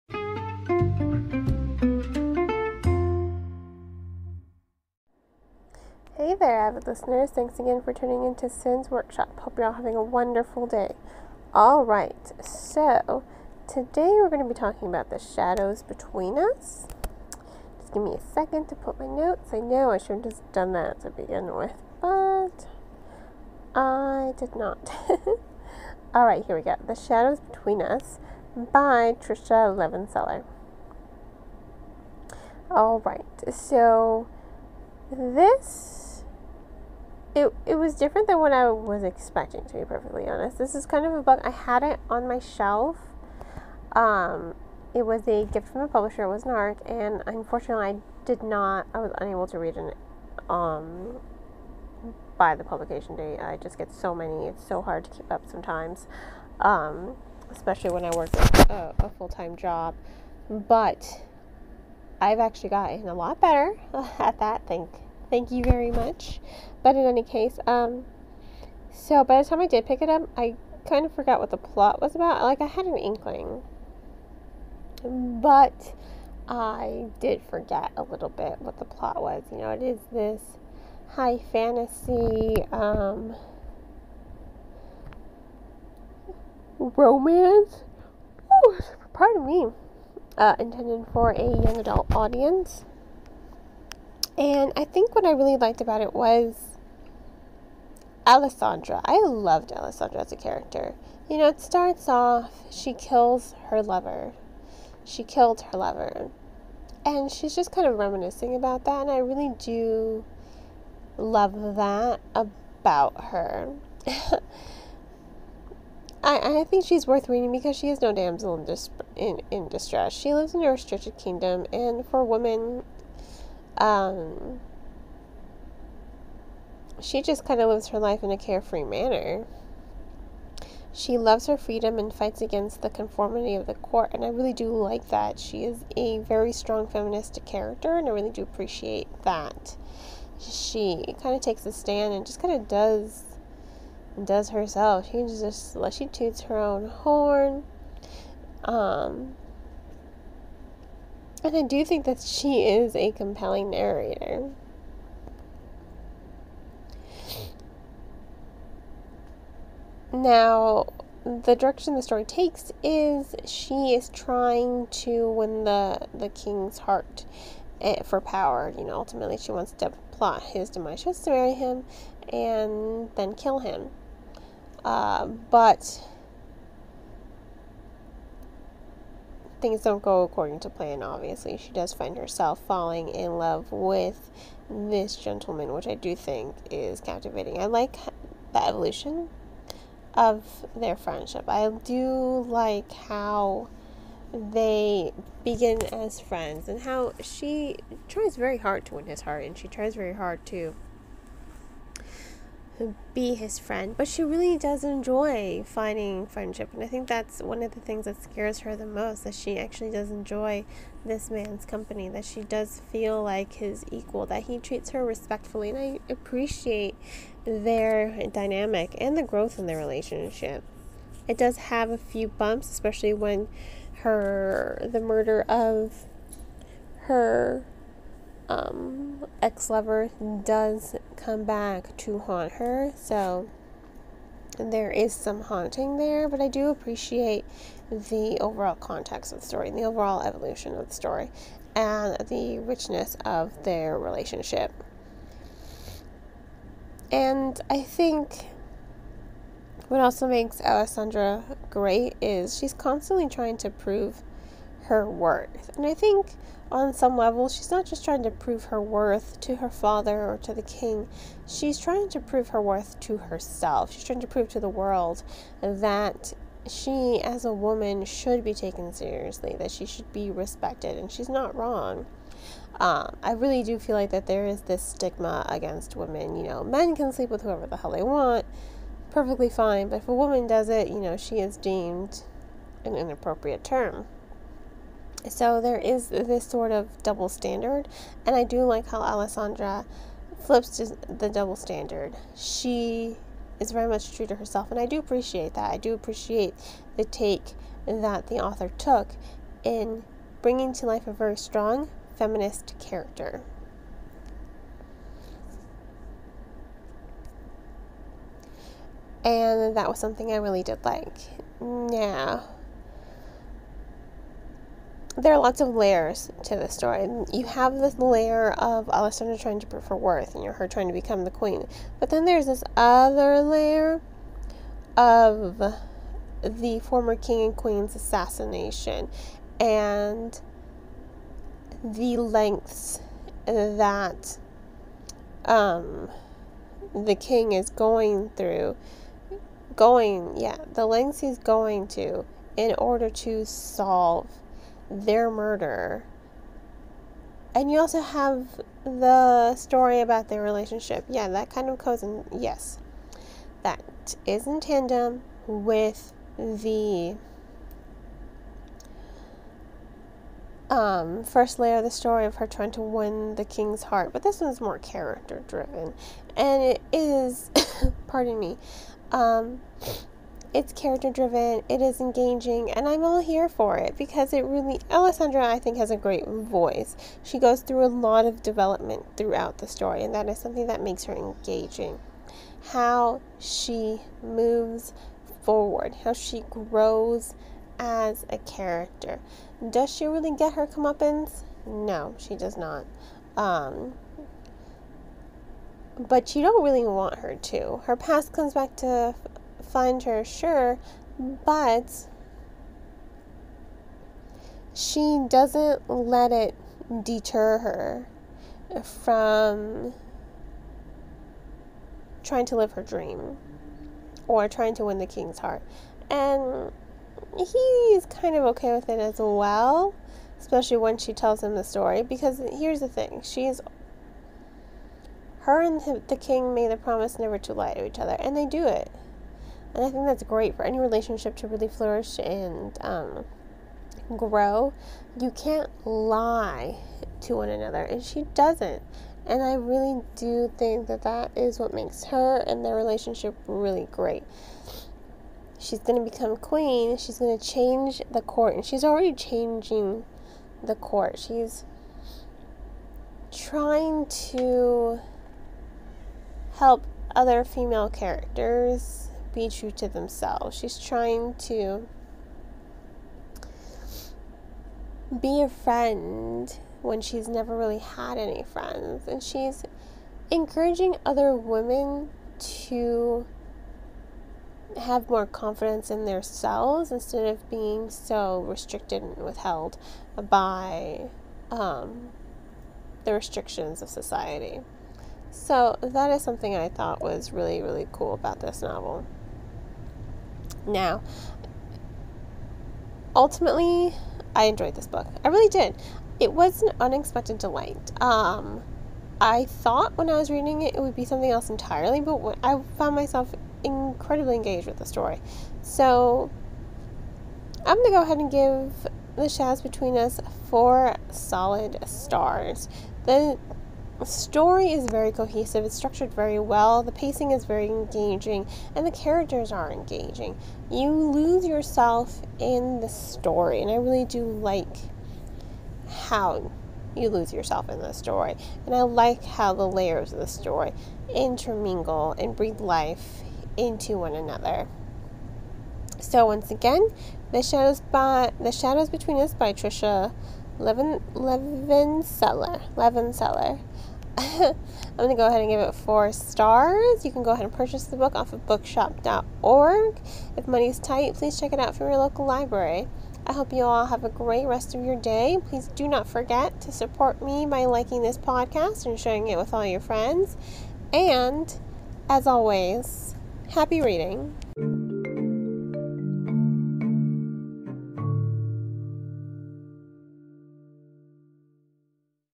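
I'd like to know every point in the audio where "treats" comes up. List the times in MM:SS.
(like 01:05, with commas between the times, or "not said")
03:34.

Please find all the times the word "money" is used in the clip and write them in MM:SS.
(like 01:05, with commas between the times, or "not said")
09:10.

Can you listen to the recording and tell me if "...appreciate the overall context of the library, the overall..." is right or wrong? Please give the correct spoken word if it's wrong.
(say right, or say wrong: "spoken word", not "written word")
wrong: "story", not "library".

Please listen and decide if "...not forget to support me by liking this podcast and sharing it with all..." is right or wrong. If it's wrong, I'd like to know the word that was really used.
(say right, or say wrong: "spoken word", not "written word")
right.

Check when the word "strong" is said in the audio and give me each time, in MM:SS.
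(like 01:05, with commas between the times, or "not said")
02:16, 05:01.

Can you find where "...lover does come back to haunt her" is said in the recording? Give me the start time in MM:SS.
03:49.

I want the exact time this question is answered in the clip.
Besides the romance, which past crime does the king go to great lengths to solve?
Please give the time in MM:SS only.
05:26.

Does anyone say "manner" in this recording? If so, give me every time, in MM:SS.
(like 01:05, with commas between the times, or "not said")
02:08.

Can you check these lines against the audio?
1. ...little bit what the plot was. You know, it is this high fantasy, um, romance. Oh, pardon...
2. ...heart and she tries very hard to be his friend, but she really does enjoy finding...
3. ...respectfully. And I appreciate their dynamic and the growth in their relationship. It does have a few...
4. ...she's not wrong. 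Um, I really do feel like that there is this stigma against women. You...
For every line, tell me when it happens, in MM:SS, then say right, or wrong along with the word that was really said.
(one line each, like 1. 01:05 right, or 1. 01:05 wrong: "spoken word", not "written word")
1. 01:18 right
2. 03:19 right
3. 03:35 right
4. 04:31 right.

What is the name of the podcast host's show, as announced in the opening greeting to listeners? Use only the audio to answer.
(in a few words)
Cyn's Workshop.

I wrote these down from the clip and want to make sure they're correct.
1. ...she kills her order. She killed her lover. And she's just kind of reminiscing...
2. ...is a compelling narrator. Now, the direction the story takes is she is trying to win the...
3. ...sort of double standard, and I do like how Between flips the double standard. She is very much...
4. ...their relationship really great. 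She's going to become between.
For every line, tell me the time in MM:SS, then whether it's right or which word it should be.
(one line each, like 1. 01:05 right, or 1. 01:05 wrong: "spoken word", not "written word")
1. 01:42 wrong: "lover", not "order"
2. 02:32 right
3. 04:46 wrong: "Alessandra", not "Between"
4. 07:22 wrong: "queen", not "between".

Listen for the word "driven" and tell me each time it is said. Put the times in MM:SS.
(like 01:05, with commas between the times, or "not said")
06:05, 06:11.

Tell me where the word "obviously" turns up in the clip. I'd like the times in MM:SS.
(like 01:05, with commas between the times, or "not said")
03:01.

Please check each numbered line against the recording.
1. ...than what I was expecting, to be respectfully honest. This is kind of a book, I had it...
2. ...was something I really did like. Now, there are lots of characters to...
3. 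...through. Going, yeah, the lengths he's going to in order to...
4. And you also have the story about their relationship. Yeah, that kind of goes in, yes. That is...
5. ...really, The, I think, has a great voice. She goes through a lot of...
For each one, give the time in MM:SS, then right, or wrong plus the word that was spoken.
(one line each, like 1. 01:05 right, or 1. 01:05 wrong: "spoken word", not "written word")
1. 00:38 wrong: "perfectly", not "respectfully"
2. 05:09 wrong: "layers", not "characters"
3. 05:38 right
4. 05:47 right
5. 06:14 wrong: "Alessandra", not "The".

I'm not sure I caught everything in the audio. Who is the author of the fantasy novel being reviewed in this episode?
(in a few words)
Tricia Levenseller.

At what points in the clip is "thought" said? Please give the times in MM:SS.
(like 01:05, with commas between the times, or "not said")
08:06, 08:19.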